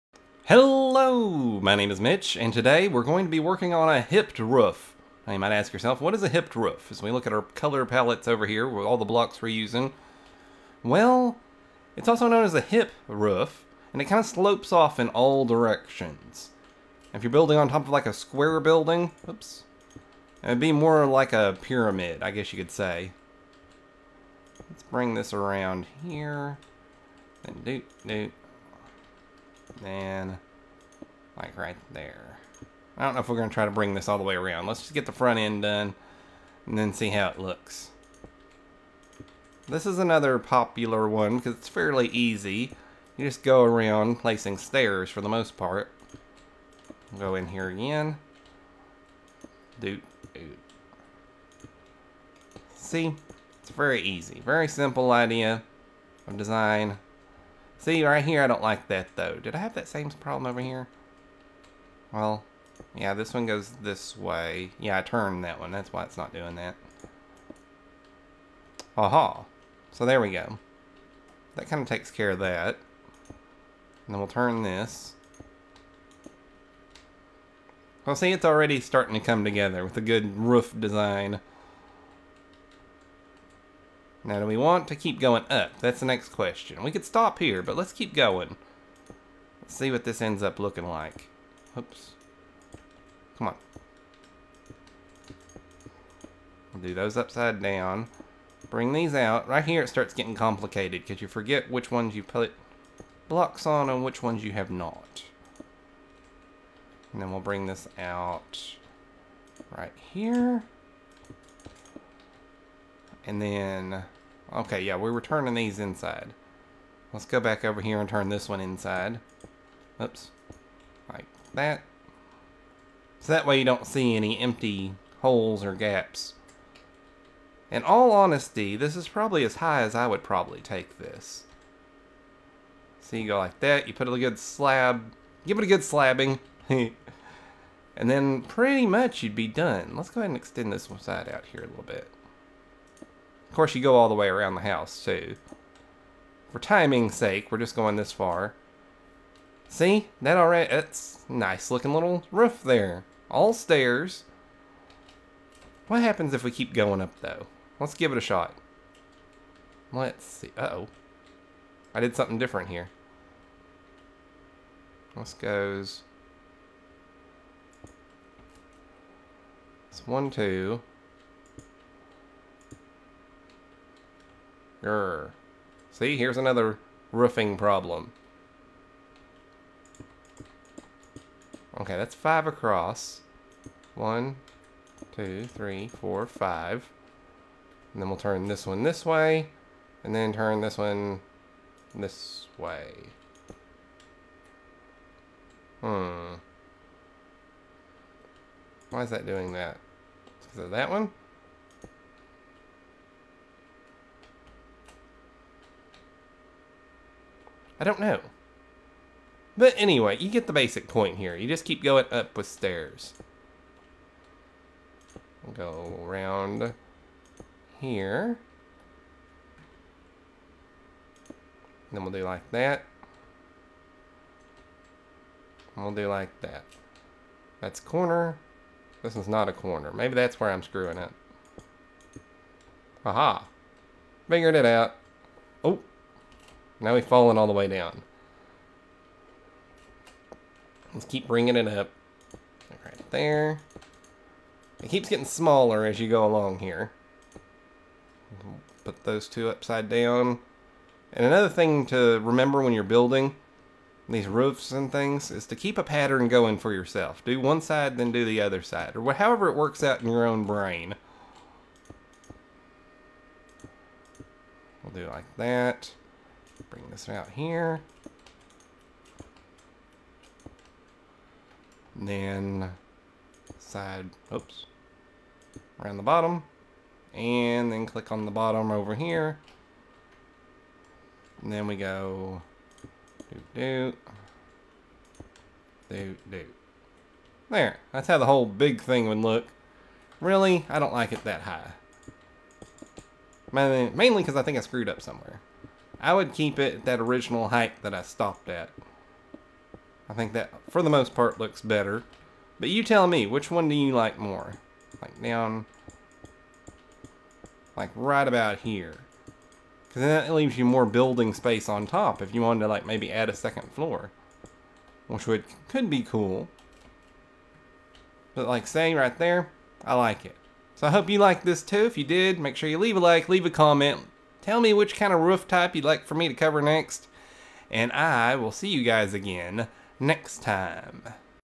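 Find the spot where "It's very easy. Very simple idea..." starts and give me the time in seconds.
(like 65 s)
53 s.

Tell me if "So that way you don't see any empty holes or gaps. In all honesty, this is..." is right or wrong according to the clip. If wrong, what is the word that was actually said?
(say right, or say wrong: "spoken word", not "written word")
right.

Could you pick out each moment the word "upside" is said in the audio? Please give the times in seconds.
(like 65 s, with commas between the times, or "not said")
97 s, 249 s.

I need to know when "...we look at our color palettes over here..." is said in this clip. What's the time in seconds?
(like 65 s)
7 s.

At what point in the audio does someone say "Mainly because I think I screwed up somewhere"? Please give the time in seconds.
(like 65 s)
293 s.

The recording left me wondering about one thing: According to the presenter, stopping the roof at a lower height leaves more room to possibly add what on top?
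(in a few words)
a second floor.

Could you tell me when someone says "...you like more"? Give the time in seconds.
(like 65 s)
303 s.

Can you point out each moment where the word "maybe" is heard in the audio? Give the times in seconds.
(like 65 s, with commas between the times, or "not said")
229 s, 312 s.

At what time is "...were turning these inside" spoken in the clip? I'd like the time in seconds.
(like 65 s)
115 s.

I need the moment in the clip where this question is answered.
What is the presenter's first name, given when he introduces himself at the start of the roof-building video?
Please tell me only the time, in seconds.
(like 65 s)
2 s.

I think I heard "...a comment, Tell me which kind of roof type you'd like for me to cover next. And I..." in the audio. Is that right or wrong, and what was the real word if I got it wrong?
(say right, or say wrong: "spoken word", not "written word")
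right.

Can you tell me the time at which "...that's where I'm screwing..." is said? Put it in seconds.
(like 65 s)
230 s.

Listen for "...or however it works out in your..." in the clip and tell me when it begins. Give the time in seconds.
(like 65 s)
258 s.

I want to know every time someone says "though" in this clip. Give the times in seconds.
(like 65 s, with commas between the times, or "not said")
59 s, 157 s.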